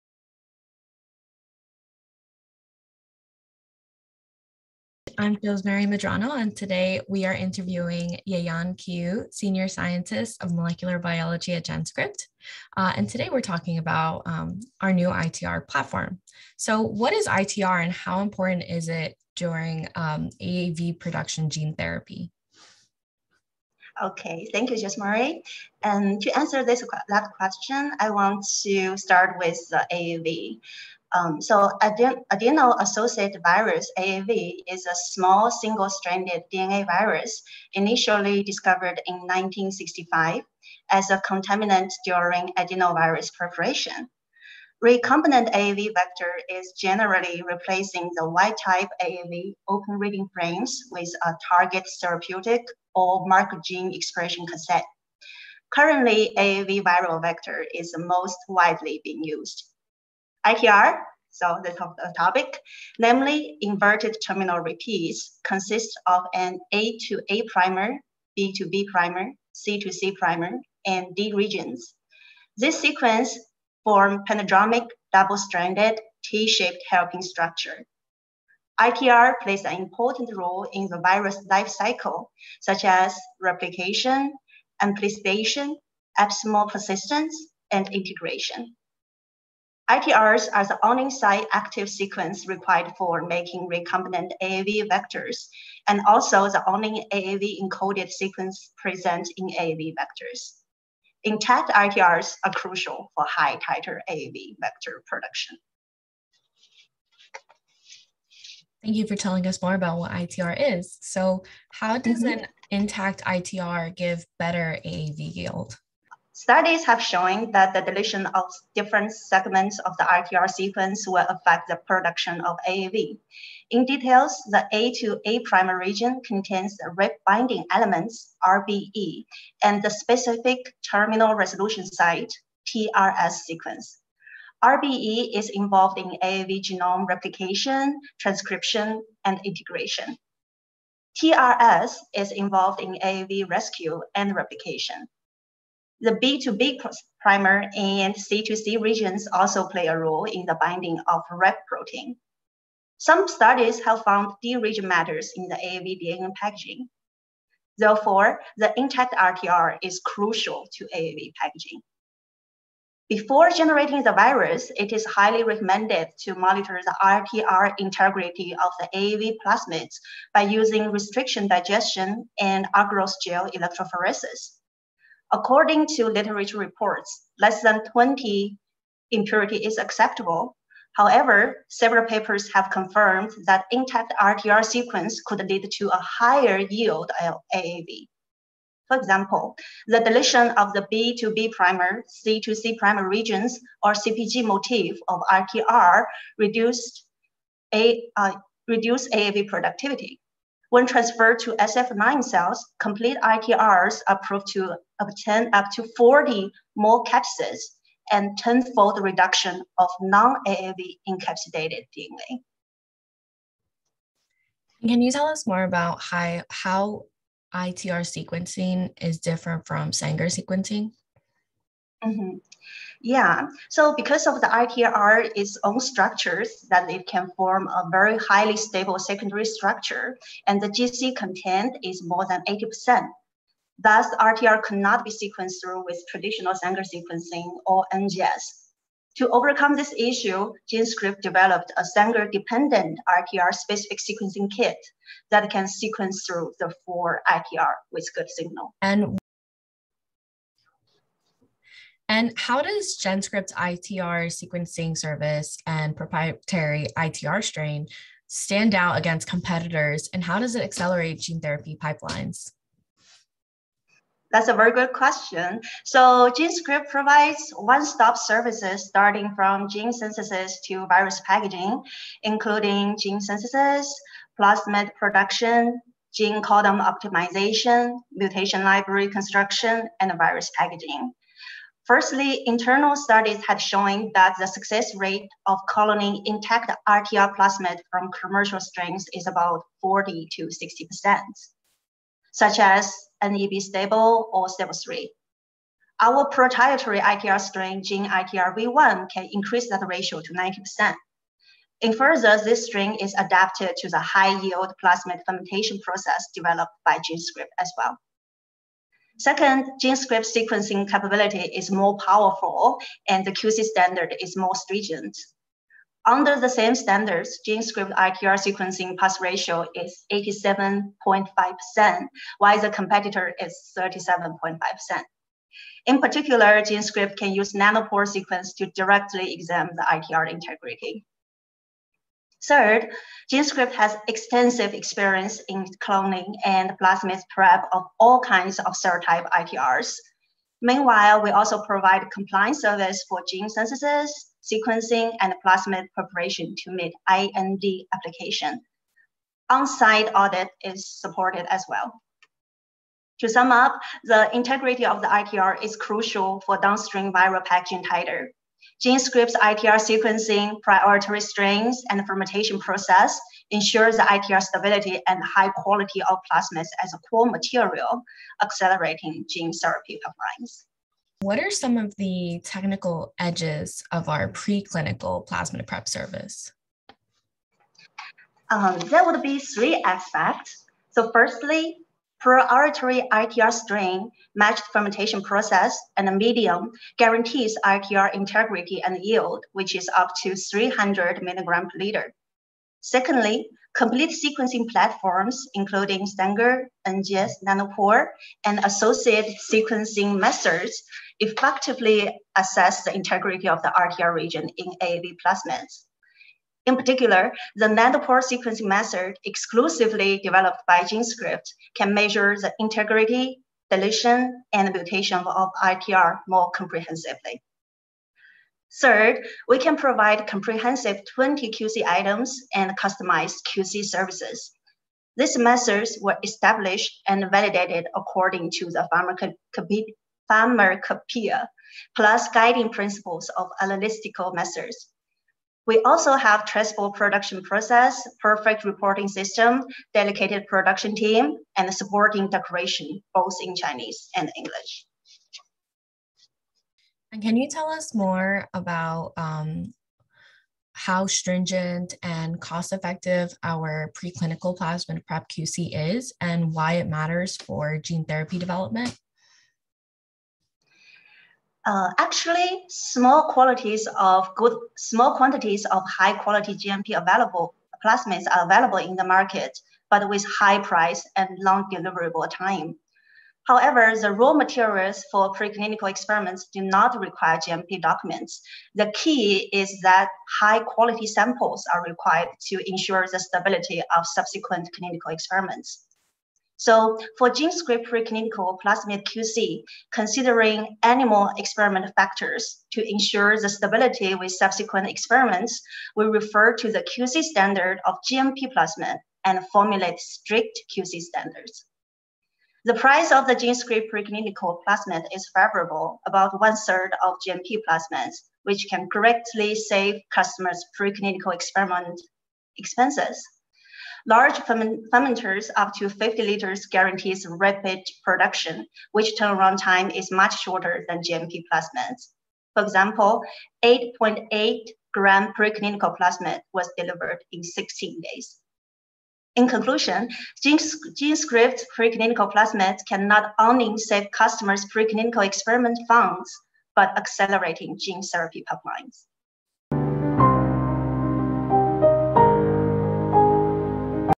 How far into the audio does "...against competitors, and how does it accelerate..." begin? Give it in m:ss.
4:18.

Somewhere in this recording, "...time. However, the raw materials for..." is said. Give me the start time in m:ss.
7:52.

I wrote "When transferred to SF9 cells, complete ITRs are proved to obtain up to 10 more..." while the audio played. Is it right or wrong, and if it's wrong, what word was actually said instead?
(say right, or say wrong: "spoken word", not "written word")
wrong: "40", not "10".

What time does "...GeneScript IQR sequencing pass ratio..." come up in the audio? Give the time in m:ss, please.
5:17.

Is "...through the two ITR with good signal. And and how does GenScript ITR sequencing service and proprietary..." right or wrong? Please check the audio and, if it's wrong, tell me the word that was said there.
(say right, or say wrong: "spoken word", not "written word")
wrong: "four", not "two".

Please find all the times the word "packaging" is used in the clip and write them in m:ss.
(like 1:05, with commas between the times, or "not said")
2:36, 2:41, 4:31, 4:40, 5:57.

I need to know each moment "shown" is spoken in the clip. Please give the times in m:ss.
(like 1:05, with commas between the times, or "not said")
1:57, 4:43.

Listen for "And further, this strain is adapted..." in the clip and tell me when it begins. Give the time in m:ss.
5:01.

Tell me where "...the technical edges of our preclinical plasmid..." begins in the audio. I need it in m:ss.
6:11.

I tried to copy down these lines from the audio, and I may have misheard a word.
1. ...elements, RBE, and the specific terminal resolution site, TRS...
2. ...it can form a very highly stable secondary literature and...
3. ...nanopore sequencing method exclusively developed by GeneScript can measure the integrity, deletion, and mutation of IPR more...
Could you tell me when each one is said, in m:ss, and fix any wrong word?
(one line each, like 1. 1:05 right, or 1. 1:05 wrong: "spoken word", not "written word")
1. 2:07 right
2. 3:46 wrong: "structure", not "literature"
3. 6:47 right.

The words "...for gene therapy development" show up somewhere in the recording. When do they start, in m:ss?
7:37.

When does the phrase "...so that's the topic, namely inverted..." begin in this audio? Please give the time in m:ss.
1:01.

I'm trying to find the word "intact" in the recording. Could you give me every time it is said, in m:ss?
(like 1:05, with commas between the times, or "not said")
1:41, 1:52, 2:38, 3:03, 4:46.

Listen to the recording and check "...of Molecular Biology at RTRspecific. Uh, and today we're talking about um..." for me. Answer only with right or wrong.
wrong.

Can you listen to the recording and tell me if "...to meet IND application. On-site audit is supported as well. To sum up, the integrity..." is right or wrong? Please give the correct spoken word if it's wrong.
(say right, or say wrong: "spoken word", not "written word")
right.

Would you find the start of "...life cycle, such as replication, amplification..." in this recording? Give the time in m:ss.
1:21.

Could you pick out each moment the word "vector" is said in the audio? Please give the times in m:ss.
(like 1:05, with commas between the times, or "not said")
0:45, 0:57, 1:34, 1:39, 1:44.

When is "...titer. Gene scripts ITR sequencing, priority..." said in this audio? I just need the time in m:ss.
5:57.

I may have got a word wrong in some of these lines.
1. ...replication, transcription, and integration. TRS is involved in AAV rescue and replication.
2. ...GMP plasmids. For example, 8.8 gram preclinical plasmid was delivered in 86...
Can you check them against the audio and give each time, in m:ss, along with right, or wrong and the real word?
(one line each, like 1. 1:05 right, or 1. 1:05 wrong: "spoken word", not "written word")
1. 2:17 right
2. 8:41 wrong: "16", not "86".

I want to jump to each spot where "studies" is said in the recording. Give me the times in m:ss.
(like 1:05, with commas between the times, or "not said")
1:56, 2:33, 4:42.